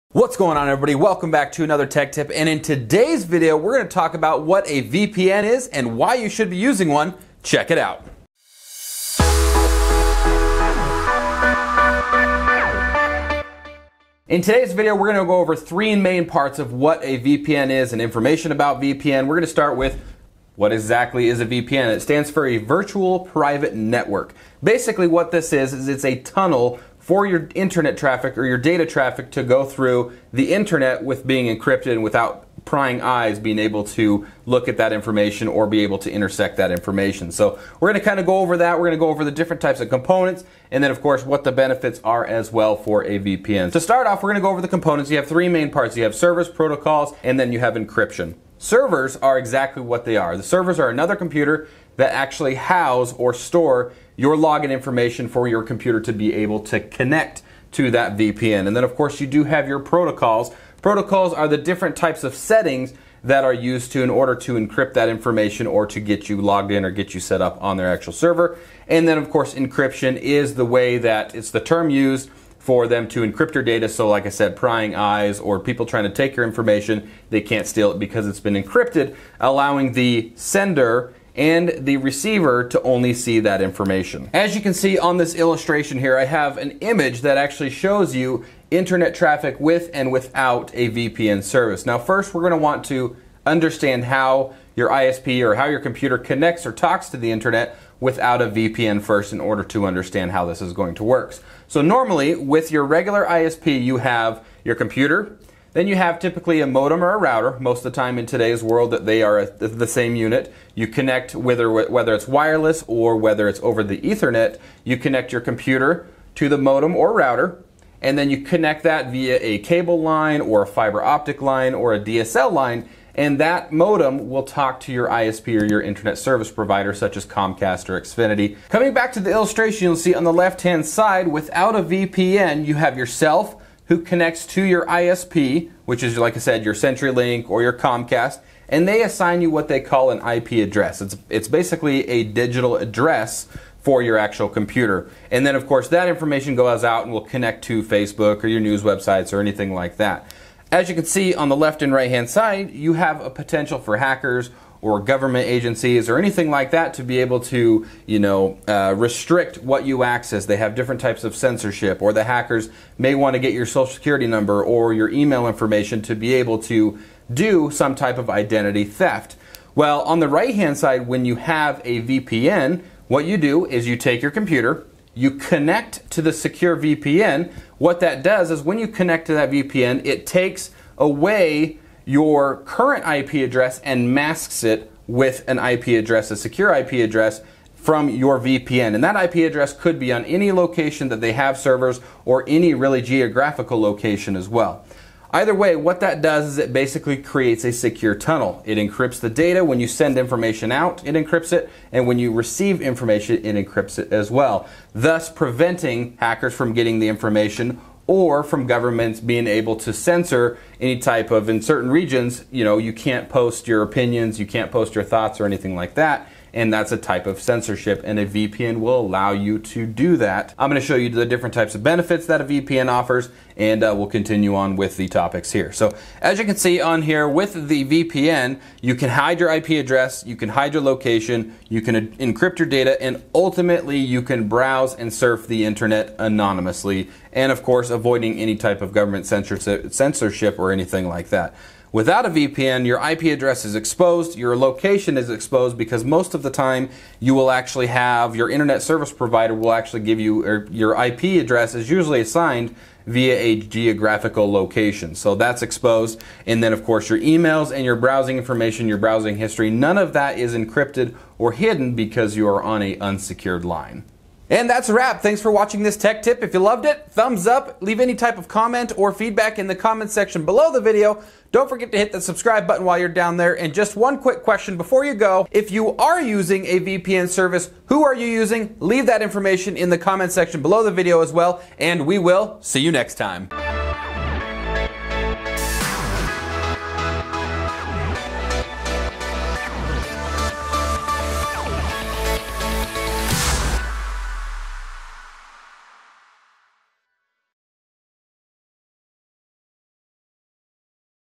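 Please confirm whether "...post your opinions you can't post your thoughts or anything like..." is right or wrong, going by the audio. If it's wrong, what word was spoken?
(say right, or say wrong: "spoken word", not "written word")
right.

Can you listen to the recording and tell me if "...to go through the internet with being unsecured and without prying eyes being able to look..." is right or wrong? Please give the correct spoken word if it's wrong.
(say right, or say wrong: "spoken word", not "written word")
wrong: "encrypted", not "unsecured".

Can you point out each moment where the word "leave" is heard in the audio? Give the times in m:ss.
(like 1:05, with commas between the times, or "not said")
4:27, 4:38.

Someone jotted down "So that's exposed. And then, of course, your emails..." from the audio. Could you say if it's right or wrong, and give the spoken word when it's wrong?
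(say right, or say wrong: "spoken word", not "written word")
right.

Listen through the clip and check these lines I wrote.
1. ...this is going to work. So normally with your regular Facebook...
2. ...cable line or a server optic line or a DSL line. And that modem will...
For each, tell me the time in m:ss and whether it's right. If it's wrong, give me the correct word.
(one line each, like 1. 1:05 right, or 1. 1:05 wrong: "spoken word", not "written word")
1. 1:40 wrong: "ISP", not "Facebook"
2. 1:59 wrong: "fiber", not "server".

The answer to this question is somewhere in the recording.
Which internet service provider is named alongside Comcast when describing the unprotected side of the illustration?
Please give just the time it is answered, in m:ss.
2:16.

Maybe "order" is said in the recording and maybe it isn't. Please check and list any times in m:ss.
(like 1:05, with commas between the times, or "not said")
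1:04, 1:39.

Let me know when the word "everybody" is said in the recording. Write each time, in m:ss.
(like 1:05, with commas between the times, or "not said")
0:00.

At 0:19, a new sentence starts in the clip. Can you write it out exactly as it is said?
We're gonna start with what exactly is a VPN?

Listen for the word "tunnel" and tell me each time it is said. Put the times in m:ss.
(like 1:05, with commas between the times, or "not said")
0:26, 3:18.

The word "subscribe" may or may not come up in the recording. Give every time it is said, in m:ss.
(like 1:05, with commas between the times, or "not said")
4:32.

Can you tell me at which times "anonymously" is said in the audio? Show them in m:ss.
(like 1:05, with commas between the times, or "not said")
3:56.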